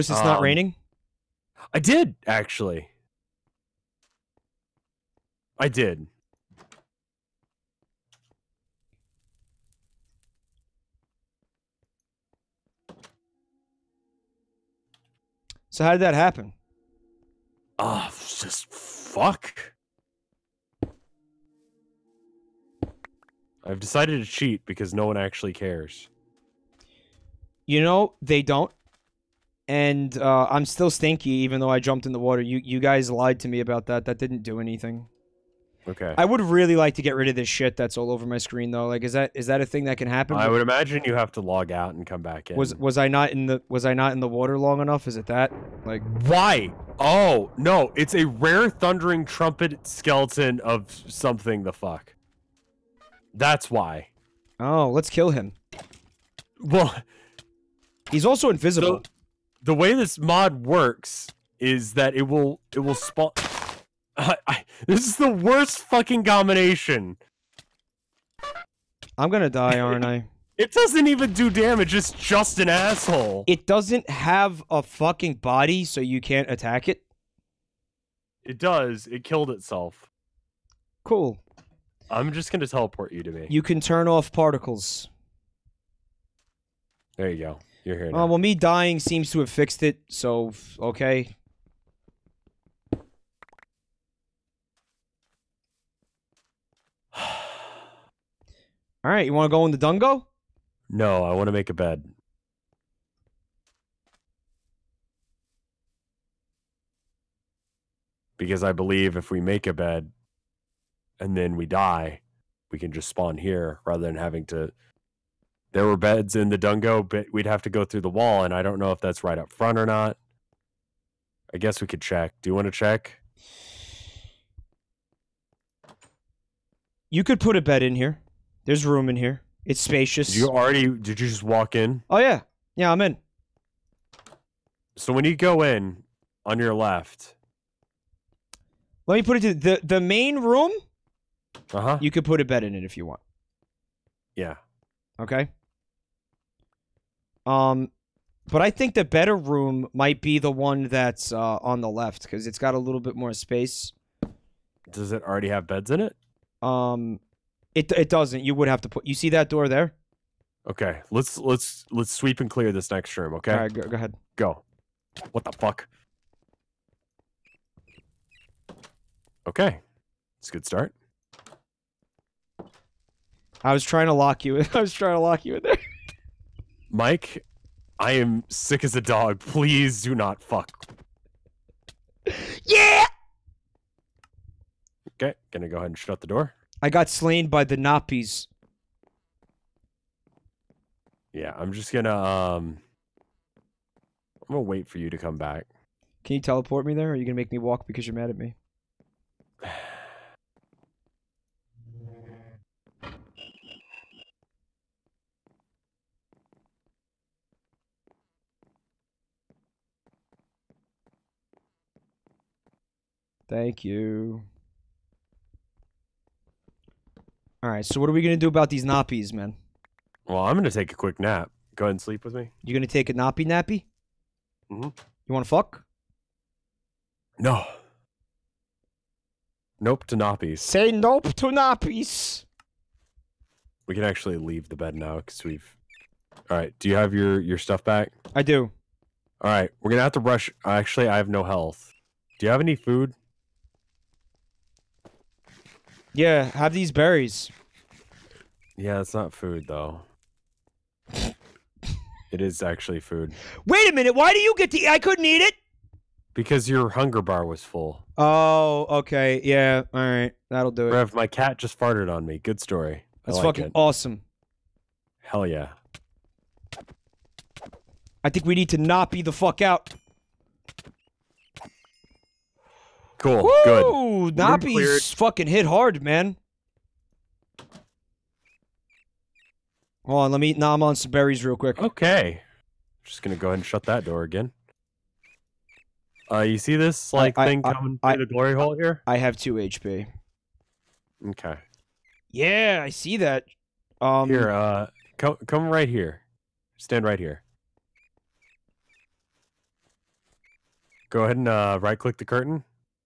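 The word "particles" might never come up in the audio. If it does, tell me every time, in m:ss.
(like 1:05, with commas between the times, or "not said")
1:24.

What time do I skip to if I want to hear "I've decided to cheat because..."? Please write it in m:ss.
0:23.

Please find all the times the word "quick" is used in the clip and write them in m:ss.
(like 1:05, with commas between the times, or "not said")
3:40, 4:41.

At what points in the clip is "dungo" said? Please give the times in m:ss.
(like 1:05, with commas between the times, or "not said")
1:39, 1:56.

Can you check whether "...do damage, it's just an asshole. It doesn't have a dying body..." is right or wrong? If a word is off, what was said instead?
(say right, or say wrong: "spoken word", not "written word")
wrong: "fucking", not "dying".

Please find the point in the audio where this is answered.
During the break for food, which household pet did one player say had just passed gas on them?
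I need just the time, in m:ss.
4:21.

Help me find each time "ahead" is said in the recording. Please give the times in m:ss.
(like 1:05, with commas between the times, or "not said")
2:43, 3:05, 3:41, 4:43, 5:01.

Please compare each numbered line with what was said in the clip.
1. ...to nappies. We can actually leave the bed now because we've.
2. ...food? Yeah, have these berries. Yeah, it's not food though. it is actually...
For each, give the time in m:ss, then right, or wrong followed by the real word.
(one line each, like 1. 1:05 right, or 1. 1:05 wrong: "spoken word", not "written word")
1. 3:51 right
2. 4:02 right.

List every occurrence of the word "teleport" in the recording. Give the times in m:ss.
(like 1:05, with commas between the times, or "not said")
1:22, 3:16.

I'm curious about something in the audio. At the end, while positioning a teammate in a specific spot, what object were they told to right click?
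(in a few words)
The curtain.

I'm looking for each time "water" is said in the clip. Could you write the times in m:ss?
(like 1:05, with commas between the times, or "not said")
0:32, 0:44.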